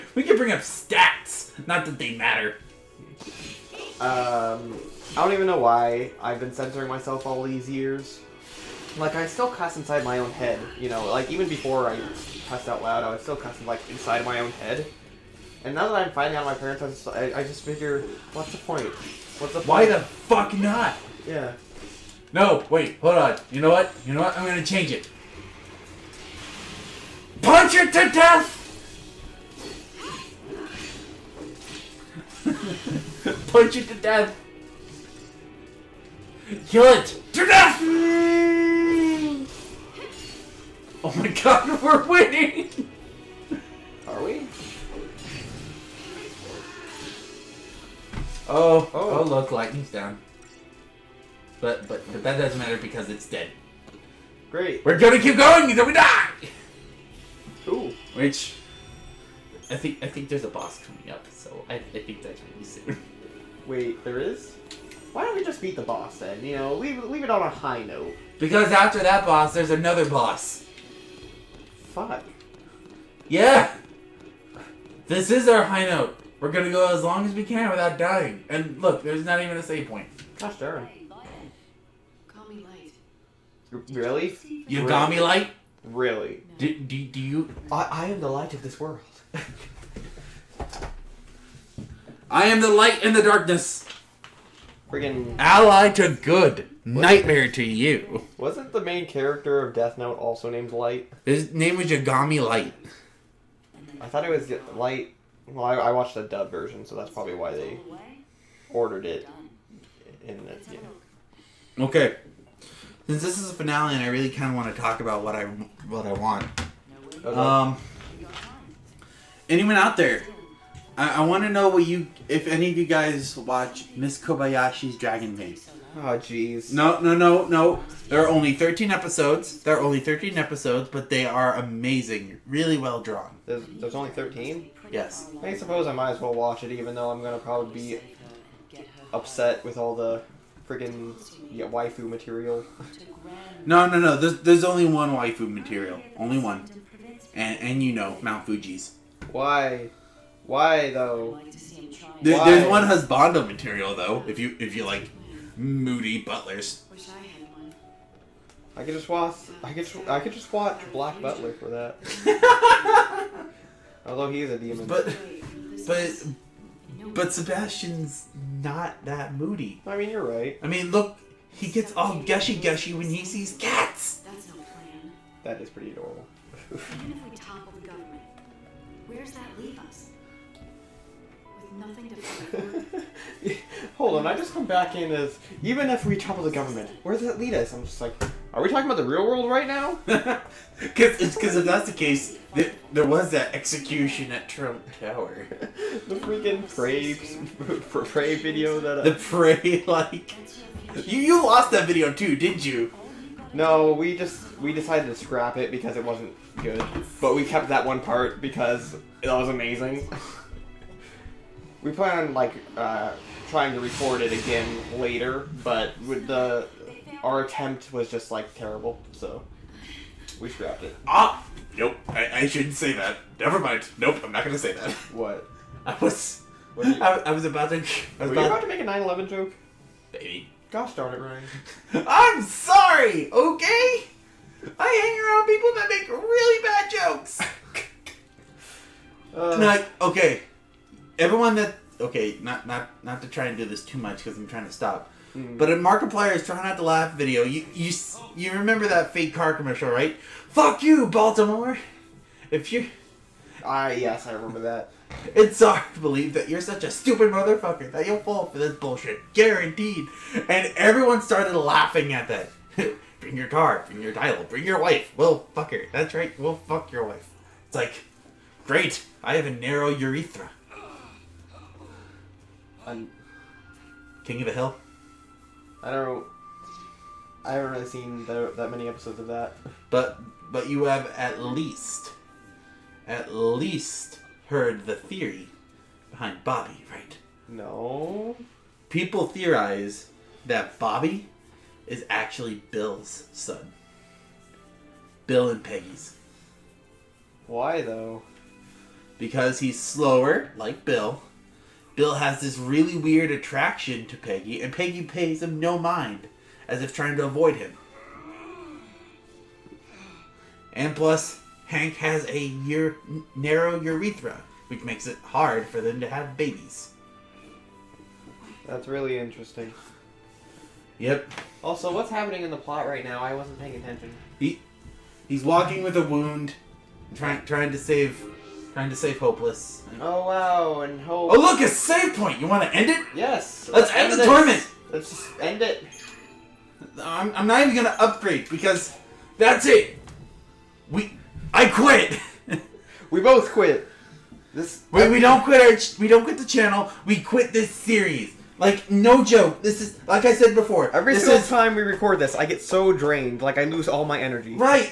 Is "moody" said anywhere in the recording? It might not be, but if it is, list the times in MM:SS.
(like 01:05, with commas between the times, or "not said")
02:35, 02:49.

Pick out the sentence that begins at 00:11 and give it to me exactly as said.
Like even before I cussed out loud, I would still cuss like inside my own head.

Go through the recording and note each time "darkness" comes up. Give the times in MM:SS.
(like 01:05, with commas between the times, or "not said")
01:33.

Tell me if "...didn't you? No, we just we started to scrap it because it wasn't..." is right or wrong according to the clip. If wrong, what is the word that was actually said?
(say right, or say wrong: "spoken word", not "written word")
wrong: "decided", not "started".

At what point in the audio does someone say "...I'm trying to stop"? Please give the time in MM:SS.
04:04.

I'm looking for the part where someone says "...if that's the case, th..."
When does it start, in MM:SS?
03:11.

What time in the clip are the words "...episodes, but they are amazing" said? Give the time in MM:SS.
02:10.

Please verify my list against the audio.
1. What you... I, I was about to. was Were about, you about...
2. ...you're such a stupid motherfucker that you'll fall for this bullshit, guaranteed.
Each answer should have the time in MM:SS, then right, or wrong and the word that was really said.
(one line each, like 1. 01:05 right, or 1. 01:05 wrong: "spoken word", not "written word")
1. 03:46 right
2. 04:16 right.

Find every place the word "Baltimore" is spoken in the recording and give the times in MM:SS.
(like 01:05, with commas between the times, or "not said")
04:11.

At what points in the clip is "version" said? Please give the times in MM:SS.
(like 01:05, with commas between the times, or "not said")
01:46.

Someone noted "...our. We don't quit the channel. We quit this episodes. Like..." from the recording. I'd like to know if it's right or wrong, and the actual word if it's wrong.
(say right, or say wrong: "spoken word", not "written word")
wrong: "series", not "episodes".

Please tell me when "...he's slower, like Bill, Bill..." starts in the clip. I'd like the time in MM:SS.
04:59.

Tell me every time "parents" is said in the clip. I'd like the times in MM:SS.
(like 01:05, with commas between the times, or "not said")
00:16.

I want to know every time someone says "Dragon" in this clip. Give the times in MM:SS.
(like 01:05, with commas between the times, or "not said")
02:04.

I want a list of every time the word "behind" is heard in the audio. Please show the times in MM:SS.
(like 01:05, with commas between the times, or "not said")
04:46.